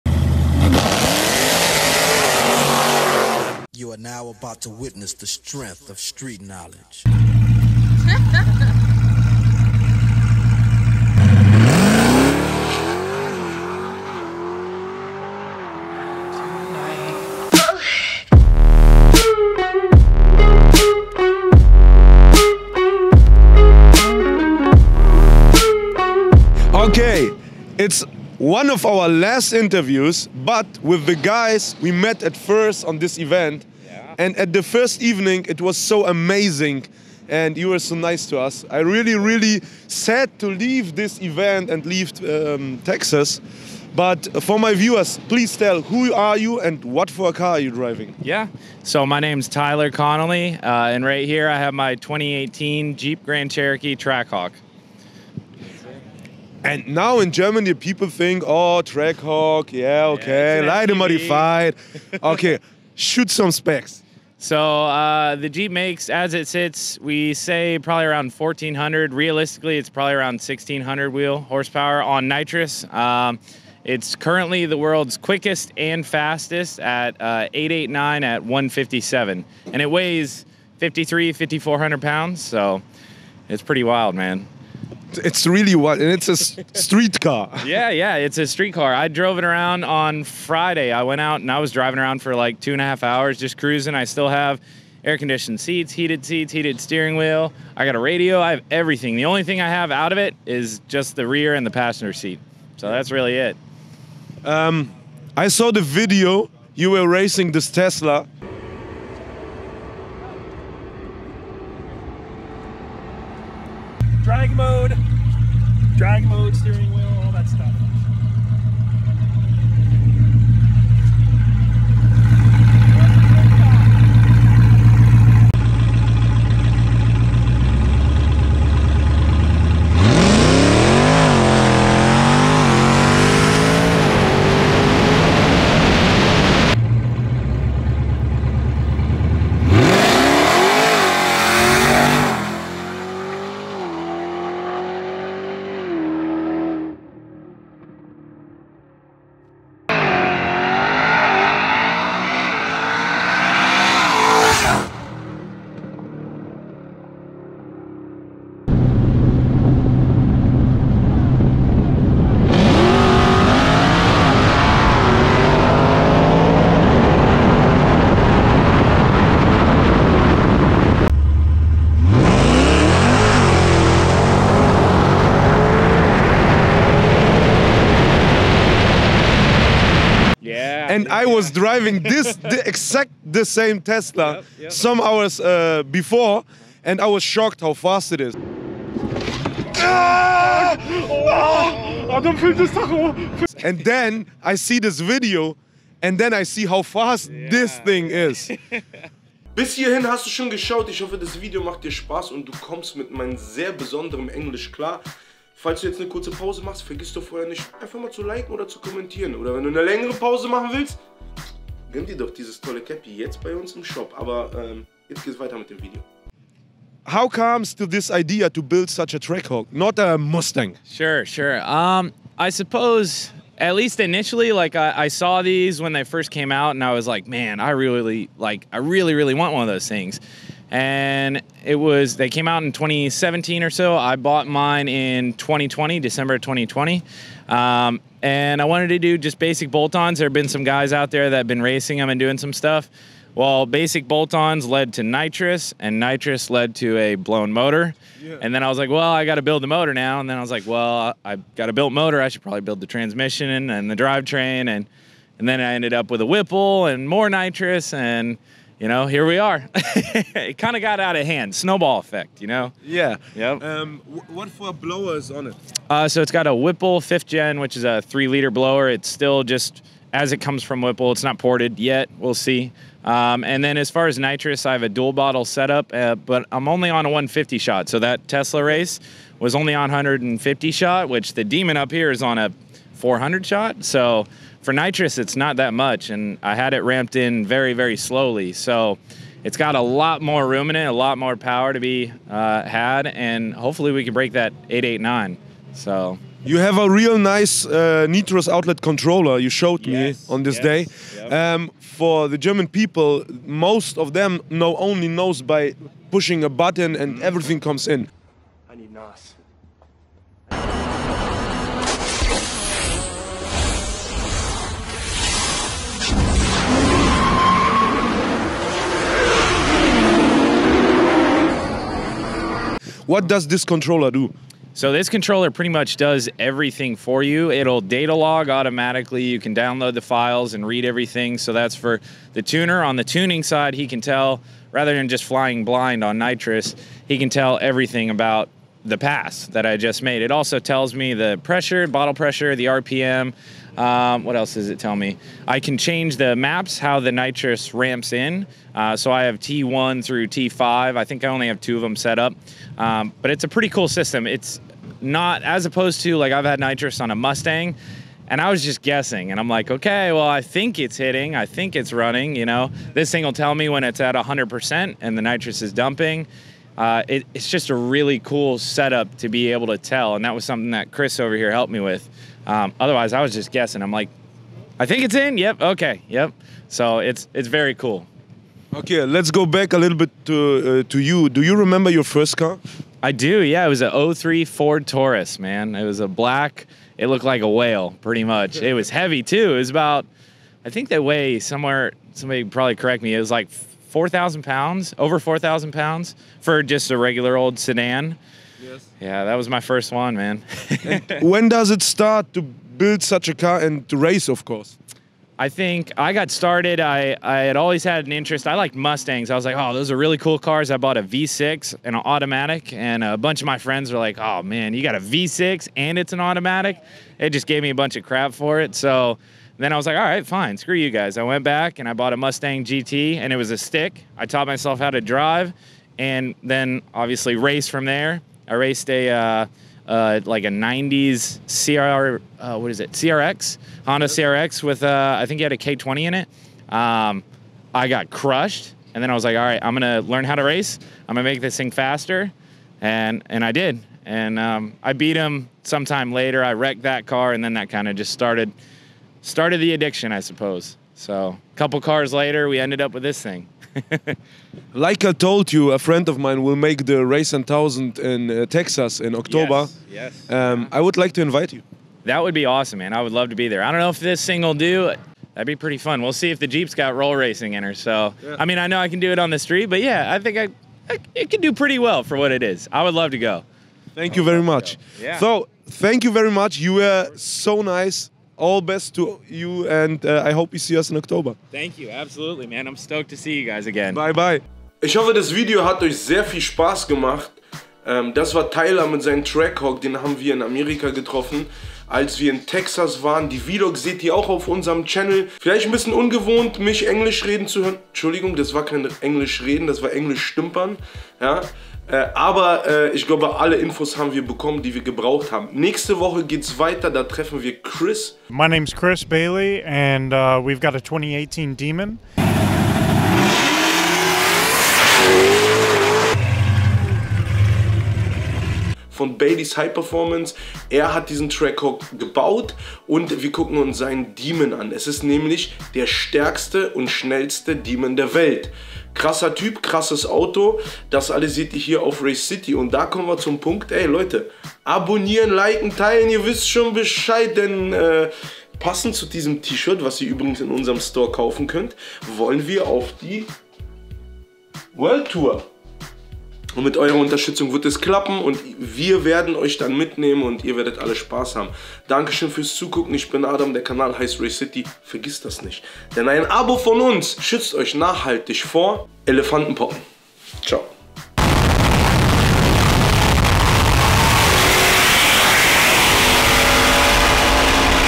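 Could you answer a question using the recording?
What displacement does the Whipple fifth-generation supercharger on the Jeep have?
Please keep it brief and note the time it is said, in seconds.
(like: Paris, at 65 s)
3 liter, at 268 s.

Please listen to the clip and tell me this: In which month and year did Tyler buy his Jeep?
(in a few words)
December 2020.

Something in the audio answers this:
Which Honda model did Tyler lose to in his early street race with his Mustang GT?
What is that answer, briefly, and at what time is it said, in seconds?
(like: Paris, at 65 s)
Honda CRX, at 433 s.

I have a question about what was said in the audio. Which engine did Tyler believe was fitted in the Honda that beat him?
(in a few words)
K20.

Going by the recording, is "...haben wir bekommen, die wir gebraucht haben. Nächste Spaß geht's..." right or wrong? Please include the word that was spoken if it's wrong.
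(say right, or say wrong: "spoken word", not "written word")
wrong: "Woche", not "Spaß".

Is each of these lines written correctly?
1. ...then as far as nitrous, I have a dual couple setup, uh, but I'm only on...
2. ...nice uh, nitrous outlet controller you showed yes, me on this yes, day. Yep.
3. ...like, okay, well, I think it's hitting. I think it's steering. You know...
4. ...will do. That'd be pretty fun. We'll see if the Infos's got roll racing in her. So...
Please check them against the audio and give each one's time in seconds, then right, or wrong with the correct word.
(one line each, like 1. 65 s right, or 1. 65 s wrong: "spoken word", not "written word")
1. 273 s wrong: "bottle", not "couple"
2. 297 s right
3. 359 s wrong: "running", not "steering"
4. 464 s wrong: "Jeep", not "Infos".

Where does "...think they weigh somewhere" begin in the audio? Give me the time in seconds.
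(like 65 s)
390 s.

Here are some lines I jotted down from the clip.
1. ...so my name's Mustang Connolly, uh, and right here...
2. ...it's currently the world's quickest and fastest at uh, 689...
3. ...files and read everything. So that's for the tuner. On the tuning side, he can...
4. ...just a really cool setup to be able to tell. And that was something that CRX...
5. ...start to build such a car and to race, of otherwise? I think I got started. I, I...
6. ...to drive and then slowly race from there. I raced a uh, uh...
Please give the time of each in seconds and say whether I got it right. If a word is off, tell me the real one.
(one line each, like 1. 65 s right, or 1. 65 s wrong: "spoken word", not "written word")
1. 48 s wrong: "Tyler", not "Mustang"
2. 73 s wrong: "889", not "689"
3. 330 s right
4. 367 s wrong: "Chris", not "CRX"
5. 401 s wrong: "course", not "otherwise"
6. 424 s wrong: "obviously", not "slowly".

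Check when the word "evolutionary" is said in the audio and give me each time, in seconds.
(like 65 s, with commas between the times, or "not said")
not said.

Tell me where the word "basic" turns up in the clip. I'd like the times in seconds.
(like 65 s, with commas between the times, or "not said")
239 s, 243 s.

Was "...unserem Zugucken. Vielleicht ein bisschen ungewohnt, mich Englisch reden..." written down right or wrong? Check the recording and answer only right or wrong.
wrong.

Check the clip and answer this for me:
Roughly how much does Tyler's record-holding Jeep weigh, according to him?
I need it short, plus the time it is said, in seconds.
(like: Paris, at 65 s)
5400 pounds, at 81 s.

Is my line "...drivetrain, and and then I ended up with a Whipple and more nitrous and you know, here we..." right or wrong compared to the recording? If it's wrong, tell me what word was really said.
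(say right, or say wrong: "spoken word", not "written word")
right.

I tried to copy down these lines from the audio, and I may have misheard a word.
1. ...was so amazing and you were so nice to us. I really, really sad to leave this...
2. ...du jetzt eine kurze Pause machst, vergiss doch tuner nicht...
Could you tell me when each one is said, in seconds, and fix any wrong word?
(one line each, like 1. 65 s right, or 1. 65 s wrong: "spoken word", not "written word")
1. 35 s right
2. 205 s wrong: "vorher", not "tuner".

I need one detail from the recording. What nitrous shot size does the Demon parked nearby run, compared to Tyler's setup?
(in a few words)
400 shot.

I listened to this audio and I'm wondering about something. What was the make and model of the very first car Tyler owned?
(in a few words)
Ford Taurus.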